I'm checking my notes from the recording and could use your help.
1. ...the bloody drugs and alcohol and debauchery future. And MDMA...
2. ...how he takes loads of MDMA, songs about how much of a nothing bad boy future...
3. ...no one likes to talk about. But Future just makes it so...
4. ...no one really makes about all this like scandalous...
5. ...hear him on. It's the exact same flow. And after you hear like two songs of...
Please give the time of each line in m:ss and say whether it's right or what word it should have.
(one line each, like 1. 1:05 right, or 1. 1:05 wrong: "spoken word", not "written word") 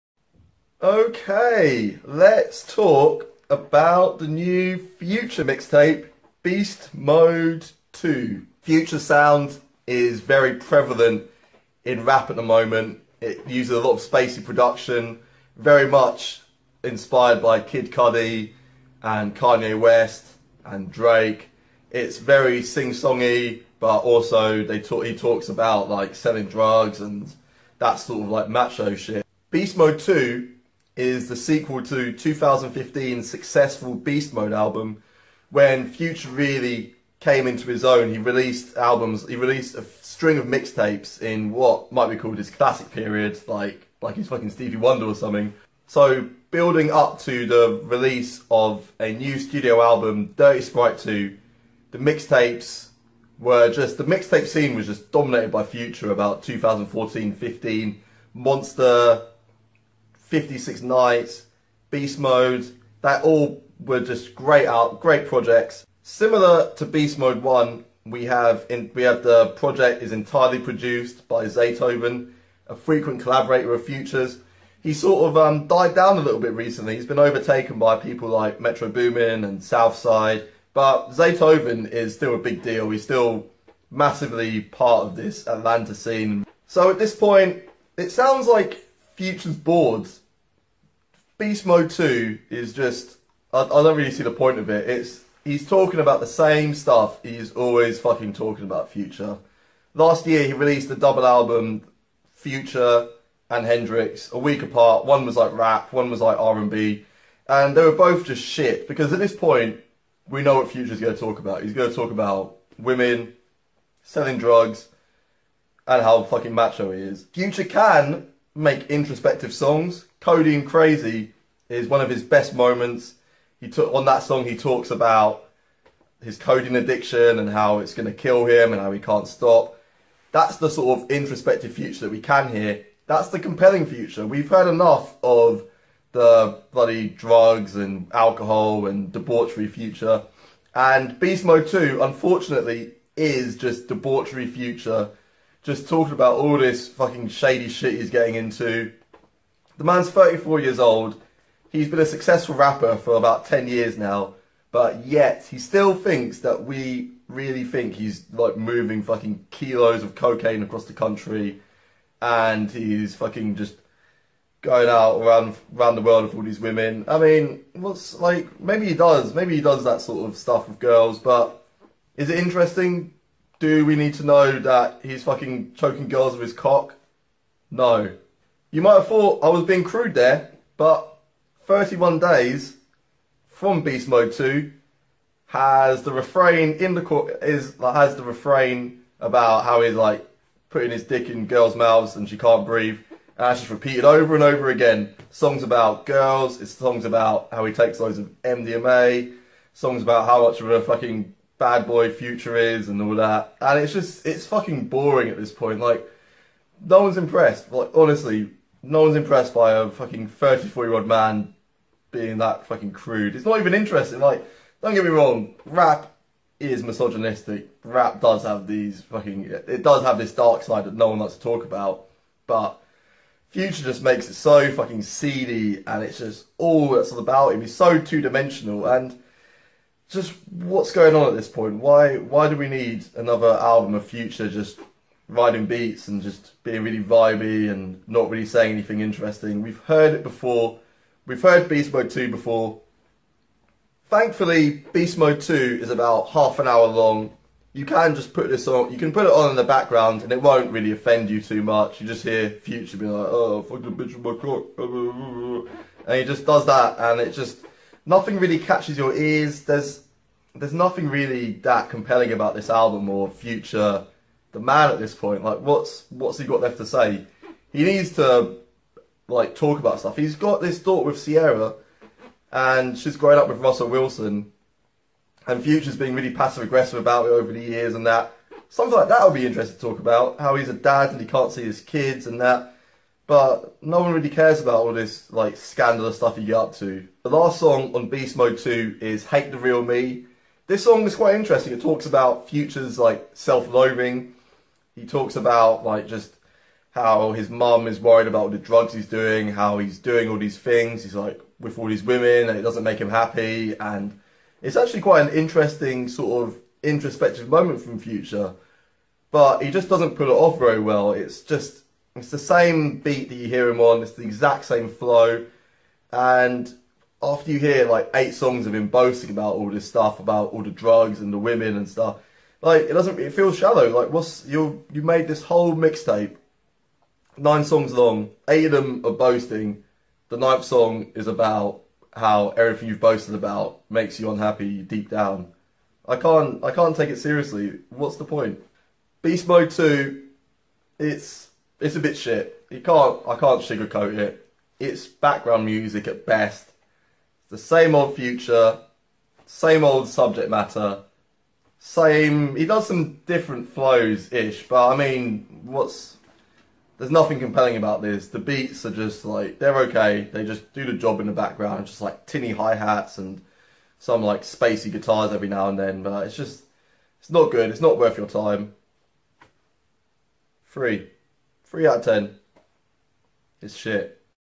1. 2:16 wrong: "Beast", not "MDMA"
2. 3:17 wrong: "fucking", not "nothing"
3. 3:40 right
4. 4:43 wrong: "cares", not "makes"
5. 5:13 wrong: "eight", not "two".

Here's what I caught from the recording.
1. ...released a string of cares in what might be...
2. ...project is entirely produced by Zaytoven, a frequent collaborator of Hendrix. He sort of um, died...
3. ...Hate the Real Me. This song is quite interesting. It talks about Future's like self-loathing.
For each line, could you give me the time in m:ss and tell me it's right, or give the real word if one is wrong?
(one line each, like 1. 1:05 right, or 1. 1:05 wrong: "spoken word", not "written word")
1. 0:39 wrong: "mixtapes", not "cares"
2. 1:09 wrong: "Futures", not "Hendrix"
3. 4:49 right.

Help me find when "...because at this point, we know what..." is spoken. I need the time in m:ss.
1:48.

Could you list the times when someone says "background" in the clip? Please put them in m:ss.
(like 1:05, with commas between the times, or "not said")
4:09, 5:45, 6:01.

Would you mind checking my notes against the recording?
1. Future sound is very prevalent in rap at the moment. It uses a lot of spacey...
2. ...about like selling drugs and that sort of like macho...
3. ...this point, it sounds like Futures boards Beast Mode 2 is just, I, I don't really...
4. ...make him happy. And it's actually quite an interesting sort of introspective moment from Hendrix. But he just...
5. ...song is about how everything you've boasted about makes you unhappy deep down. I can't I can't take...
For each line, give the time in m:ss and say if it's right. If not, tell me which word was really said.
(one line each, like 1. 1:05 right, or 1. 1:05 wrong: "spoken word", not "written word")
1. 0:08 right
2. 0:25 right
3. 1:26 right
4. 5:02 wrong: "Future", not "Hendrix"
5. 5:30 right.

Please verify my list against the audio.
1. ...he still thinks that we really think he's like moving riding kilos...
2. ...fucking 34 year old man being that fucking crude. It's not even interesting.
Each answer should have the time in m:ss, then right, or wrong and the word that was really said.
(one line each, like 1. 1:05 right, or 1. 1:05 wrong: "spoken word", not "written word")
1. 2:35 wrong: "fucking", not "riding"
2. 3:29 right.